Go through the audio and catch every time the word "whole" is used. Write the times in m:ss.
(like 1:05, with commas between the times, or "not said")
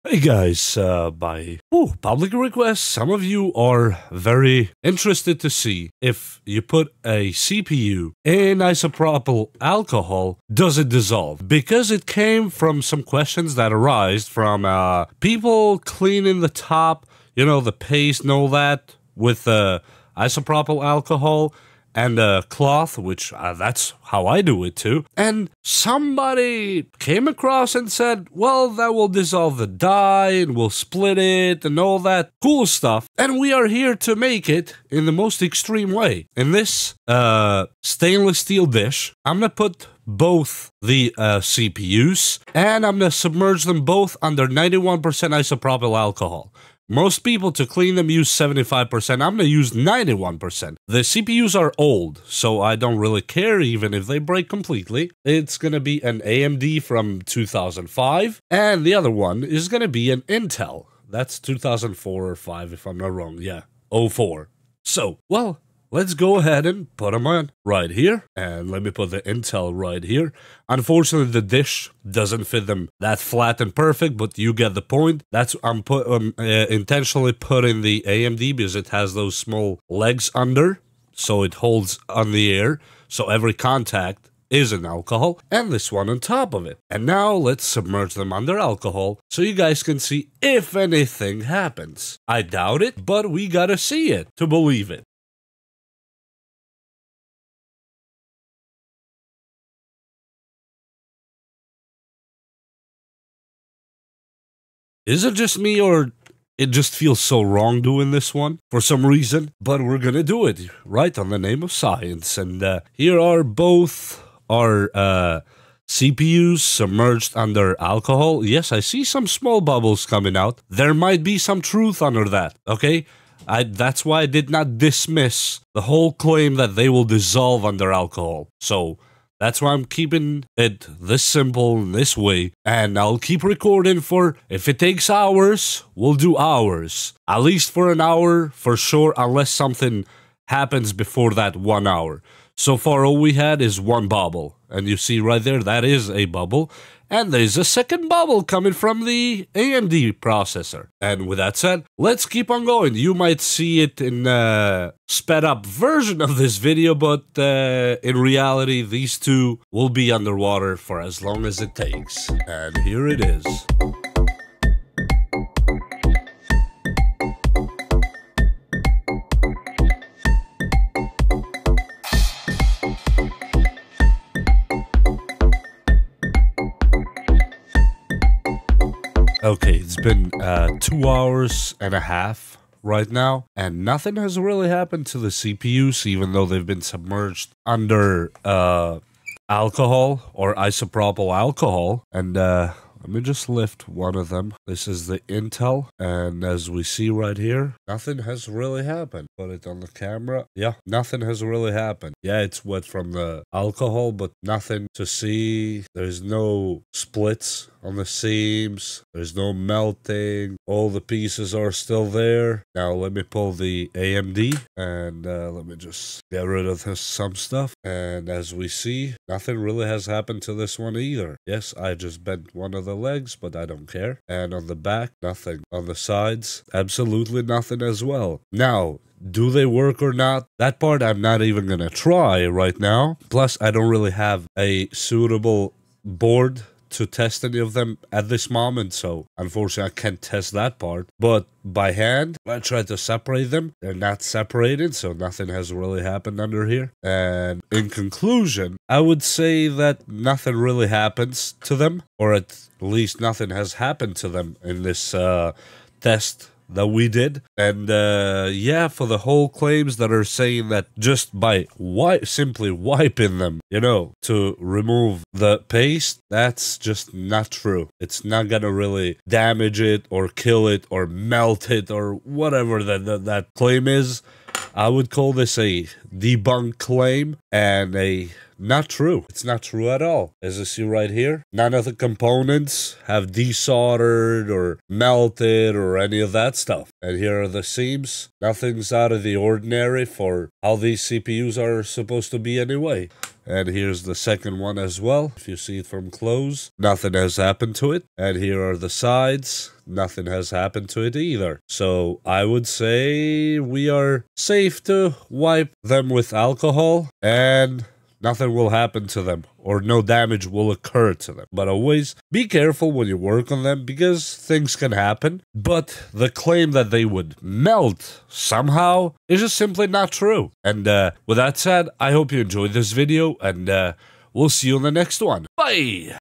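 2:05, 4:19.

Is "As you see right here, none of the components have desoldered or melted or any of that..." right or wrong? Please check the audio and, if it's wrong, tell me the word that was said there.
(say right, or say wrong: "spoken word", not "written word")
right.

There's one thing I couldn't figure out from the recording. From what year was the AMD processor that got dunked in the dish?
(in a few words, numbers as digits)
2005.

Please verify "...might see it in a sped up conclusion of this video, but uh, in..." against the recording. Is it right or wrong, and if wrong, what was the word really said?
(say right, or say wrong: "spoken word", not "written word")
wrong: "version", not "conclusion".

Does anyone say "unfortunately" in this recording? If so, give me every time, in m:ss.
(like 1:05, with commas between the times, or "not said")
1:10, 3:59.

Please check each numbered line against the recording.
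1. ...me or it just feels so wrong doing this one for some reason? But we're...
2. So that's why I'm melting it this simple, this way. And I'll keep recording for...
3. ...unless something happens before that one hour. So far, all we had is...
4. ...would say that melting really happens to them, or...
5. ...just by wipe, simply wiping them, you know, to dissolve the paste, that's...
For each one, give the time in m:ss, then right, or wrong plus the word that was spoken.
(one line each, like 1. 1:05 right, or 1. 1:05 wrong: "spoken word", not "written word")
1. 1:45 right
2. 2:08 wrong: "keeping", not "melting"
3. 2:19 right
4. 4:08 wrong: "nothing", not "melting"
5. 4:20 wrong: "remove", not "dissolve".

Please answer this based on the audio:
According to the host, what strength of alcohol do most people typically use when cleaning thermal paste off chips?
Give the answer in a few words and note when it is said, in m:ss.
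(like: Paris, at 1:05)
75%, at 0:48.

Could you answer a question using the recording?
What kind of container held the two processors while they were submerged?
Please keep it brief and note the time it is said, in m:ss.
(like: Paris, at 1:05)
stainless steel dish, at 0:37.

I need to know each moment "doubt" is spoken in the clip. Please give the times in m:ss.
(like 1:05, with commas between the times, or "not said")
1:32.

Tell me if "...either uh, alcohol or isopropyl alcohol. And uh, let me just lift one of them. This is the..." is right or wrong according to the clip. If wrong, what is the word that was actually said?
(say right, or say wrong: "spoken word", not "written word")
wrong: "under", not "either".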